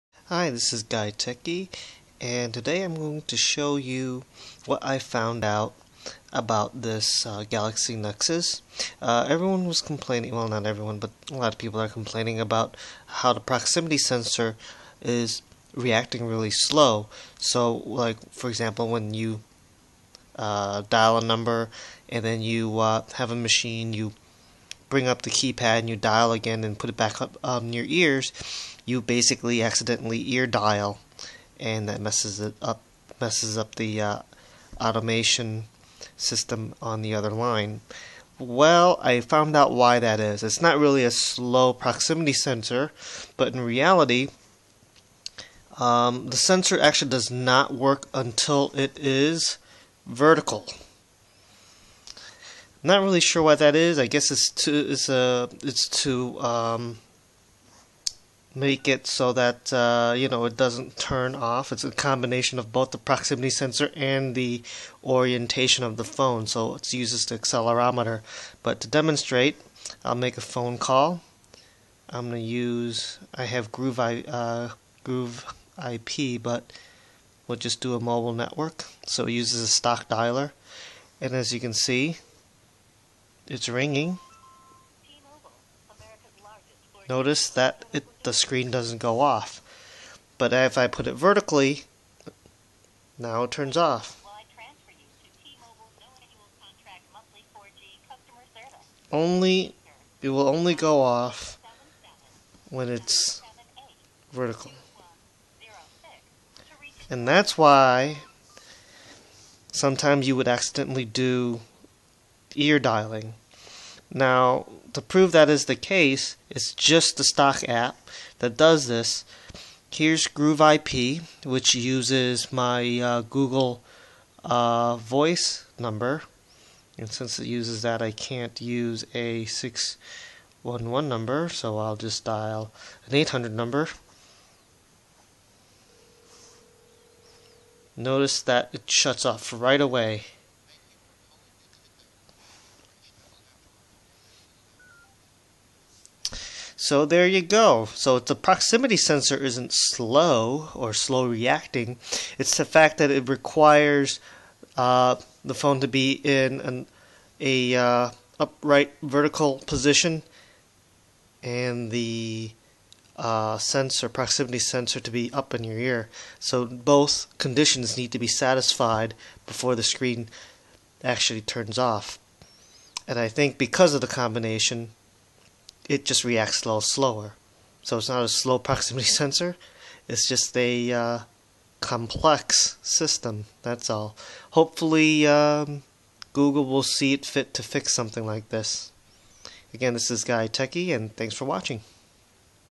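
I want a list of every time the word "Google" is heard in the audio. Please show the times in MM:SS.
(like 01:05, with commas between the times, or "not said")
02:03, 03:06.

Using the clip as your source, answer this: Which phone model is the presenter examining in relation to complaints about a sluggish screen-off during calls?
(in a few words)
Galaxy Nexus.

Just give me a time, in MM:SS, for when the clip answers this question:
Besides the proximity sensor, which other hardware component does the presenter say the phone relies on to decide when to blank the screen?
01:07.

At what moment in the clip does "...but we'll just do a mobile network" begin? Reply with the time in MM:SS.
01:16.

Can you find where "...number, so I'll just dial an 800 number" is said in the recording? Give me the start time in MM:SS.
02:11.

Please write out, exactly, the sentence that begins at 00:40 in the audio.
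It's not really a slow proximity sensor, but in reality, um, the sensor actually does not work until it is vertical.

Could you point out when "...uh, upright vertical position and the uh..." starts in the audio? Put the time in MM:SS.
02:37.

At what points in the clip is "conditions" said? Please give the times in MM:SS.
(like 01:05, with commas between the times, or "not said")
02:47.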